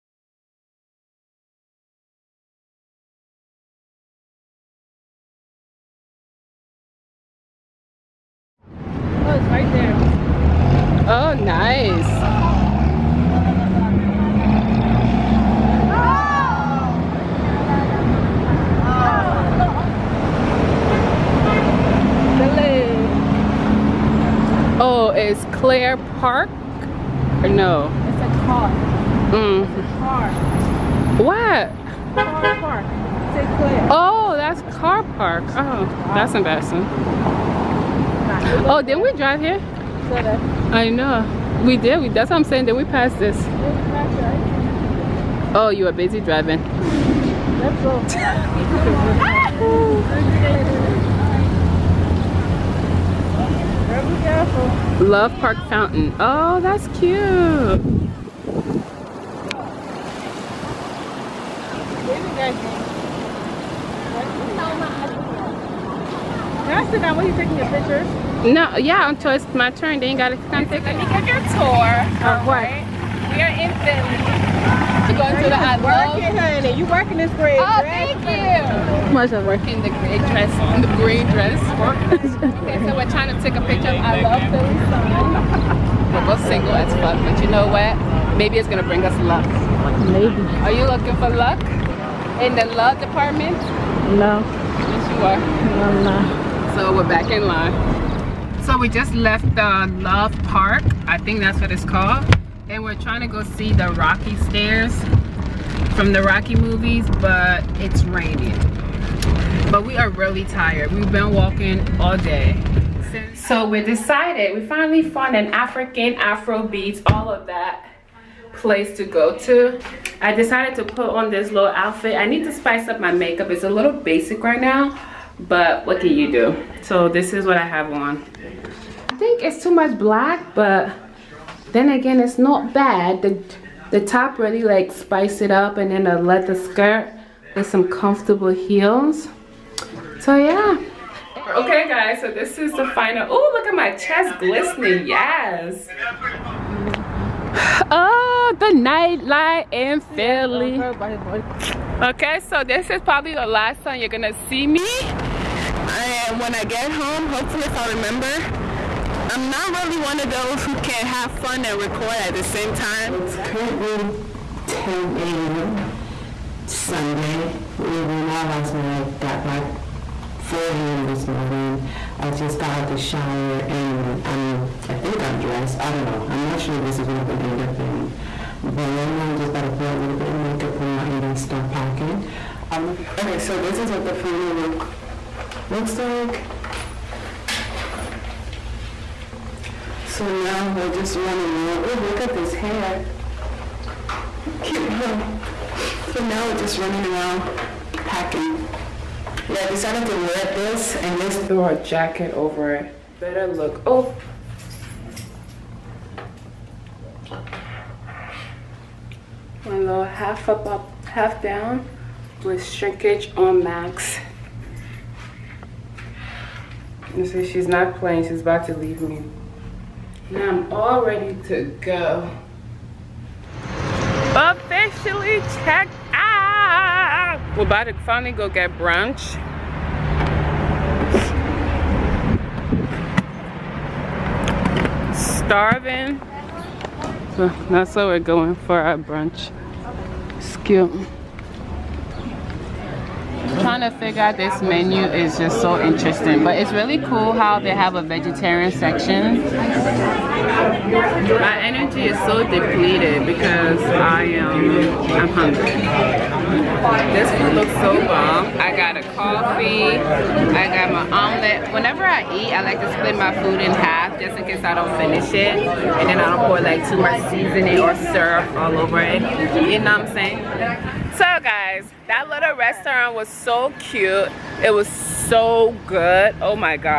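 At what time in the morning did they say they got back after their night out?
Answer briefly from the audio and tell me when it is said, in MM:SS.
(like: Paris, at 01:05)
4 a.m., at 02:50.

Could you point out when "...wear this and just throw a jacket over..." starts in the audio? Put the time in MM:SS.
03:20.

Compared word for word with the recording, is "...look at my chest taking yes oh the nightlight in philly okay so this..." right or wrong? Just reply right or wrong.
wrong.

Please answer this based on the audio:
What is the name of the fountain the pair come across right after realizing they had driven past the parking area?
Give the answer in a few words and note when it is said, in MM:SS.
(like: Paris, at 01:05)
Love Park Fountain, at 00:55.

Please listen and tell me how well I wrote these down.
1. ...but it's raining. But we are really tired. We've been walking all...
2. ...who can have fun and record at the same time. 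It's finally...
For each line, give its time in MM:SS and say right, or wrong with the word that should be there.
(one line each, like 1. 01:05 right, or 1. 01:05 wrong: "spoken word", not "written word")
1. 01:47 right
2. 02:40 wrong: "currently", not "finally".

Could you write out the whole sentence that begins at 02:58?
But right now I'm just about to put a little bit of makeup on and then start packing.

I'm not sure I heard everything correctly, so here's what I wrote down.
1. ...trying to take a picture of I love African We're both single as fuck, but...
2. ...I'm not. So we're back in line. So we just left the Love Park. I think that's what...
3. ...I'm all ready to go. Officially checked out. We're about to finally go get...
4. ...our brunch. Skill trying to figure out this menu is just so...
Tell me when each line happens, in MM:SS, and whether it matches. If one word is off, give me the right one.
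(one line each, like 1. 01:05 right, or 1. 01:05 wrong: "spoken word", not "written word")
1. 01:23 wrong: "Philly", not "African"
2. 01:35 right
3. 03:40 right
4. 03:58 right.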